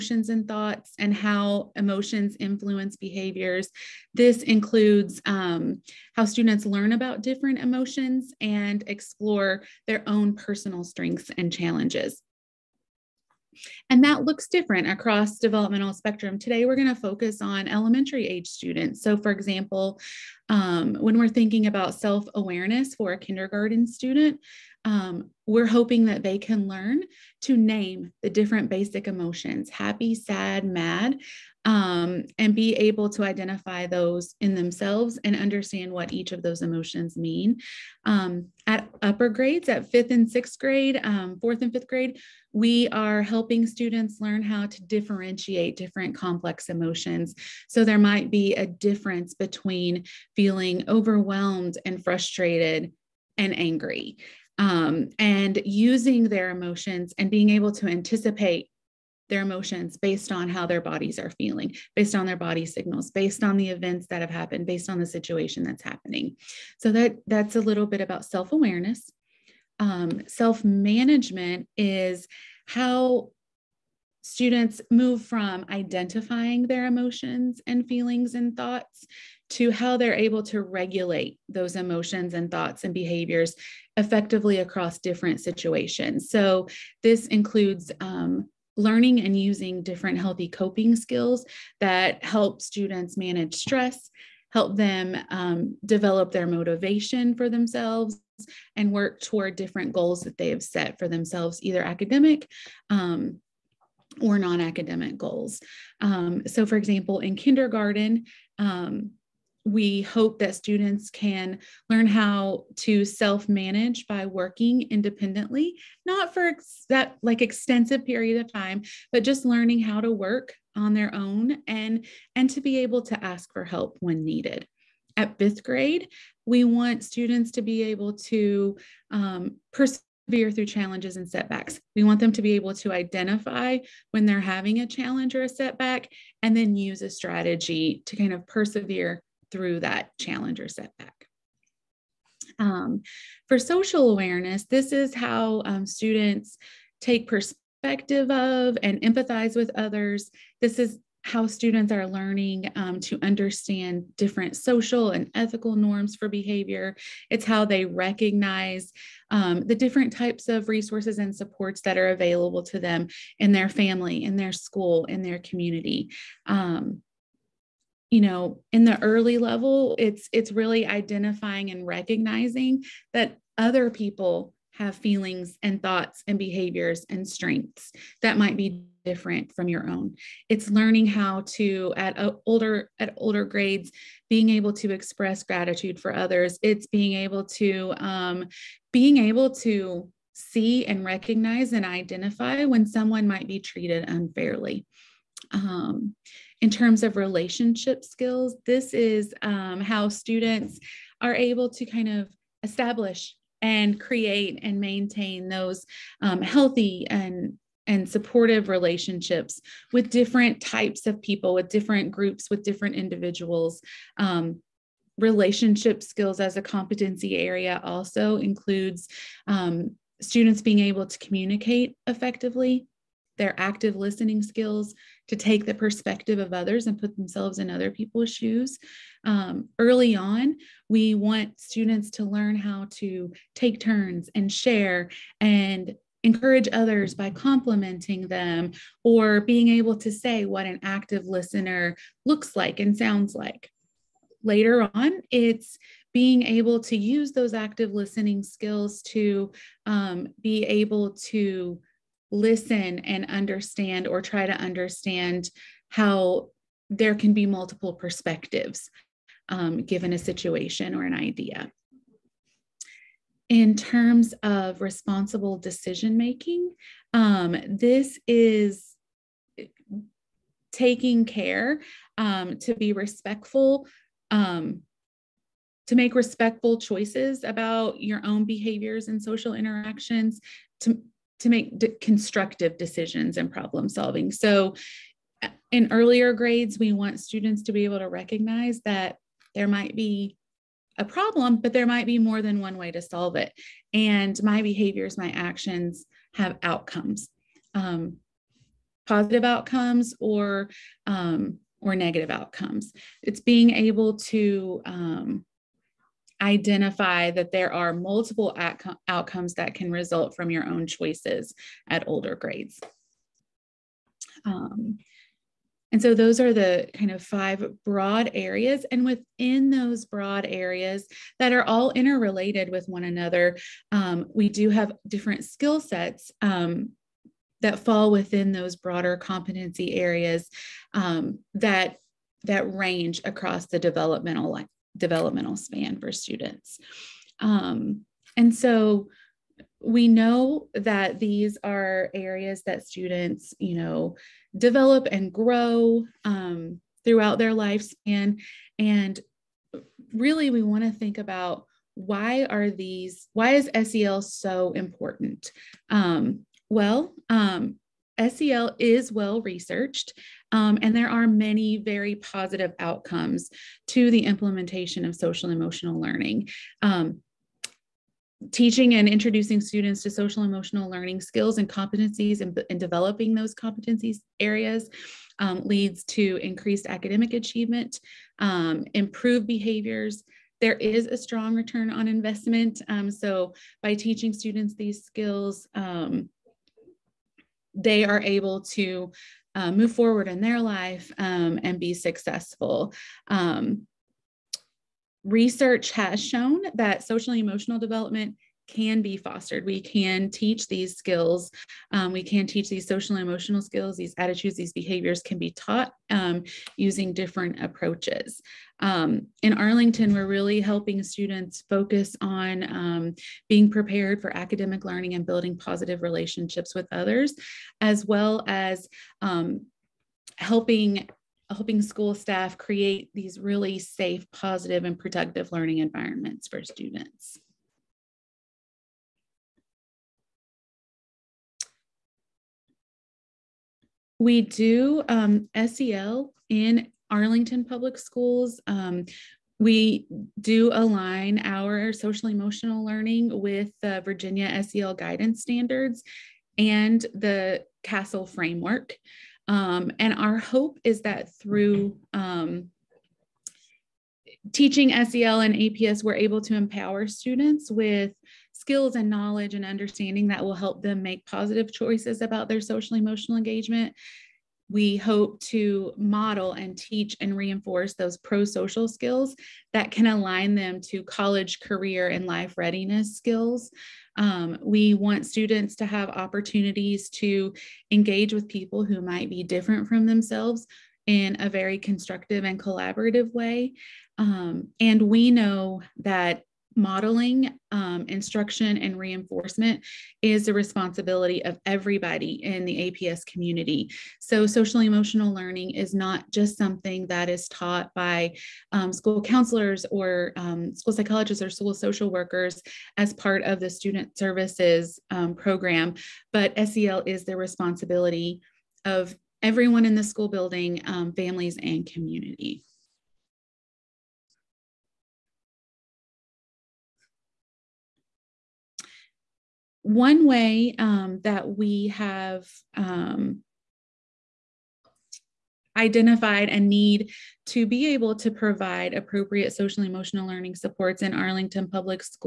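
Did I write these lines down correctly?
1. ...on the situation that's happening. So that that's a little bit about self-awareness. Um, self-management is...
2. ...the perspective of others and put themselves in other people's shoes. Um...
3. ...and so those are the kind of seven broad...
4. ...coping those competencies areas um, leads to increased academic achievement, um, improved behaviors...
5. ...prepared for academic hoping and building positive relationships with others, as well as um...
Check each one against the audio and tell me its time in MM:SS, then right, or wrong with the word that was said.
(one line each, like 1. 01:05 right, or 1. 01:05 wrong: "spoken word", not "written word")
1. 01:04 right
2. 03:45 right
3. 05:15 wrong: "five", not "seven"
4. 06:12 wrong: "developing", not "coping"
5. 06:53 wrong: "learning", not "hoping".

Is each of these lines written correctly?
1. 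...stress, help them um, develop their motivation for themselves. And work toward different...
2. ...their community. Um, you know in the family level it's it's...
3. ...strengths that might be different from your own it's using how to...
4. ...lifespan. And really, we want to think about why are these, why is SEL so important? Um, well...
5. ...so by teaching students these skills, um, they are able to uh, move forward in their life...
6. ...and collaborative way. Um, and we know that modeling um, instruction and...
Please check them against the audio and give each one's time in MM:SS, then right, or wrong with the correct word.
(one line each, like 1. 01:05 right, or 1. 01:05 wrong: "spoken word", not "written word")
1. 01:33 right
2. 02:45 wrong: "early", not "family"
3. 02:57 wrong: "learning", not "using"
4. 05:47 right
5. 06:23 right
6. 08:02 right.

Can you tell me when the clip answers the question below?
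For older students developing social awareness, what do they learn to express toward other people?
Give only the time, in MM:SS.
03:05.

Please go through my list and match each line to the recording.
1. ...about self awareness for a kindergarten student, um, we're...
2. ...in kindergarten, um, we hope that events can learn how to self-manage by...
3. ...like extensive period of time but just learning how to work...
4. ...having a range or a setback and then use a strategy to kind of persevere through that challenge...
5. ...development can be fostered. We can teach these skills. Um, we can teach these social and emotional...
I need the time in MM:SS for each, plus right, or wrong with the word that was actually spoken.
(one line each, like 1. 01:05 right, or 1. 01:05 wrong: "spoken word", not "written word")
1. 00:21 right
2. 01:47 wrong: "students", not "events"
3. 01:57 right
4. 02:14 wrong: "challenge", not "range"
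5. 06:37 right.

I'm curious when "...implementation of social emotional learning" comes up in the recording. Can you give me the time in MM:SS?
06:04.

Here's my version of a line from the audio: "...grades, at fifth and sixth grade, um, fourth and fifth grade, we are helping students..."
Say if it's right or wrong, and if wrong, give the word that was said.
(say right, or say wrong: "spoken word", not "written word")
right.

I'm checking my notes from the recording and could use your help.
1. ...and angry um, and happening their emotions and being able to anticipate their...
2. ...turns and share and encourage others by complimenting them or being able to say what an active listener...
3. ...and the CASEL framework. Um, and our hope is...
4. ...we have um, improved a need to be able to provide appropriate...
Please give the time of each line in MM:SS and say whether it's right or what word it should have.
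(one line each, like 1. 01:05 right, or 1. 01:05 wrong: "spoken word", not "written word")
1. 00:53 wrong: "using", not "happening"
2. 03:53 right
3. 07:26 right
4. 08:41 wrong: "identified", not "improved".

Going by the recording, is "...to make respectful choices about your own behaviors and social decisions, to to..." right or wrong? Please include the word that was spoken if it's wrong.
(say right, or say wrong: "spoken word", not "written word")
wrong: "interactions", not "decisions".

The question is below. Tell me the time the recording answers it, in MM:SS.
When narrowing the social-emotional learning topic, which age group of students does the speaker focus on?
00:17.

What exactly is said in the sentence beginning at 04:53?
And my behaviors, my actions have outcomes, um, positive outcomes or um, or negative outcomes.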